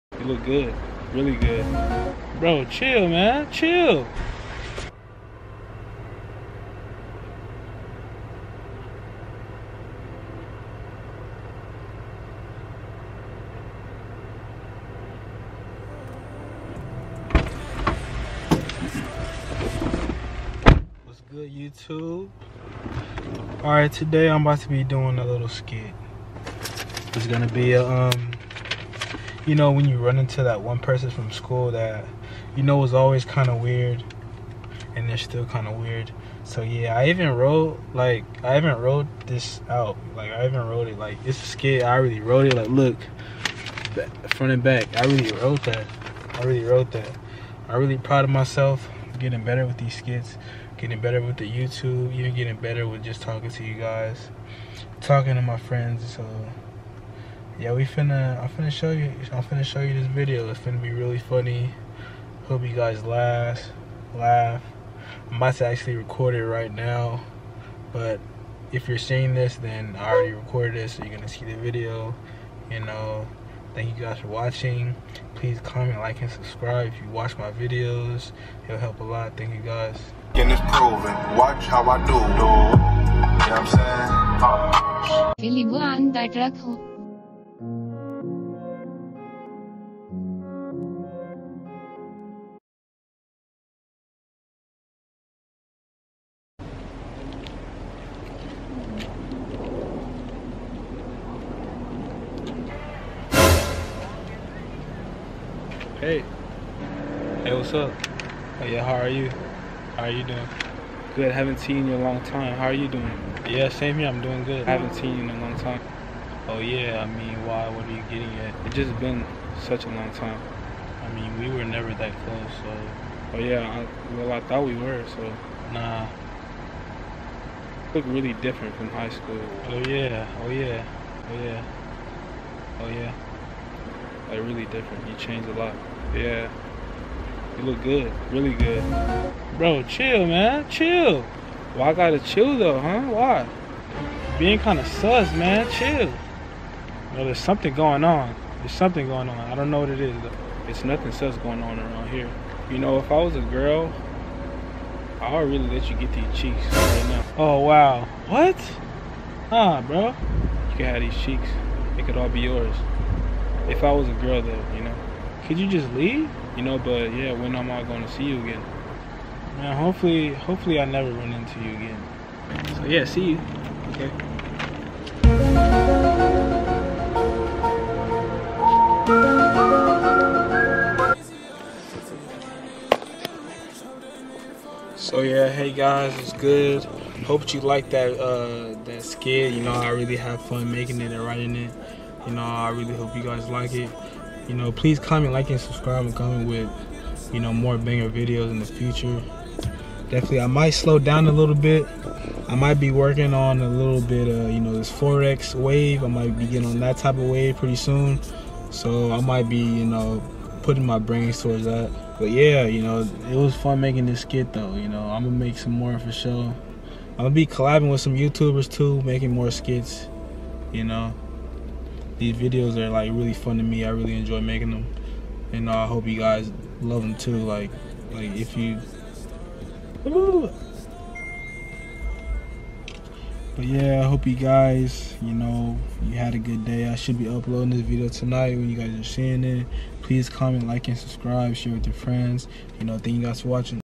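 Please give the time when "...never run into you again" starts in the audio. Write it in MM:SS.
02:50.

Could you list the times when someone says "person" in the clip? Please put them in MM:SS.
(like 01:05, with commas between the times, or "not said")
00:30.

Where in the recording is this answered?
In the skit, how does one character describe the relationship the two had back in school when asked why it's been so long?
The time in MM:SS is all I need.
02:01.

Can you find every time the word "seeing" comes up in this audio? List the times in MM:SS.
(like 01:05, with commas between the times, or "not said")
01:08, 03:59.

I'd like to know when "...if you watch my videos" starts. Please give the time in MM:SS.
01:16.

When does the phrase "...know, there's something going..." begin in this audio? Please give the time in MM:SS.
02:27.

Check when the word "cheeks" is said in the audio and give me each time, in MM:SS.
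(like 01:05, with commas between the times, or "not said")
02:36, 02:41.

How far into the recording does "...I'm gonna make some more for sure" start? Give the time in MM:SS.
03:35.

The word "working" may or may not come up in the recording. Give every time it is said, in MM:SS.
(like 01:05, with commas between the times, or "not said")
03:22.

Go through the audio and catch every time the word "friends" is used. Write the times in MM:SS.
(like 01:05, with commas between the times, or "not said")
00:55, 04:01.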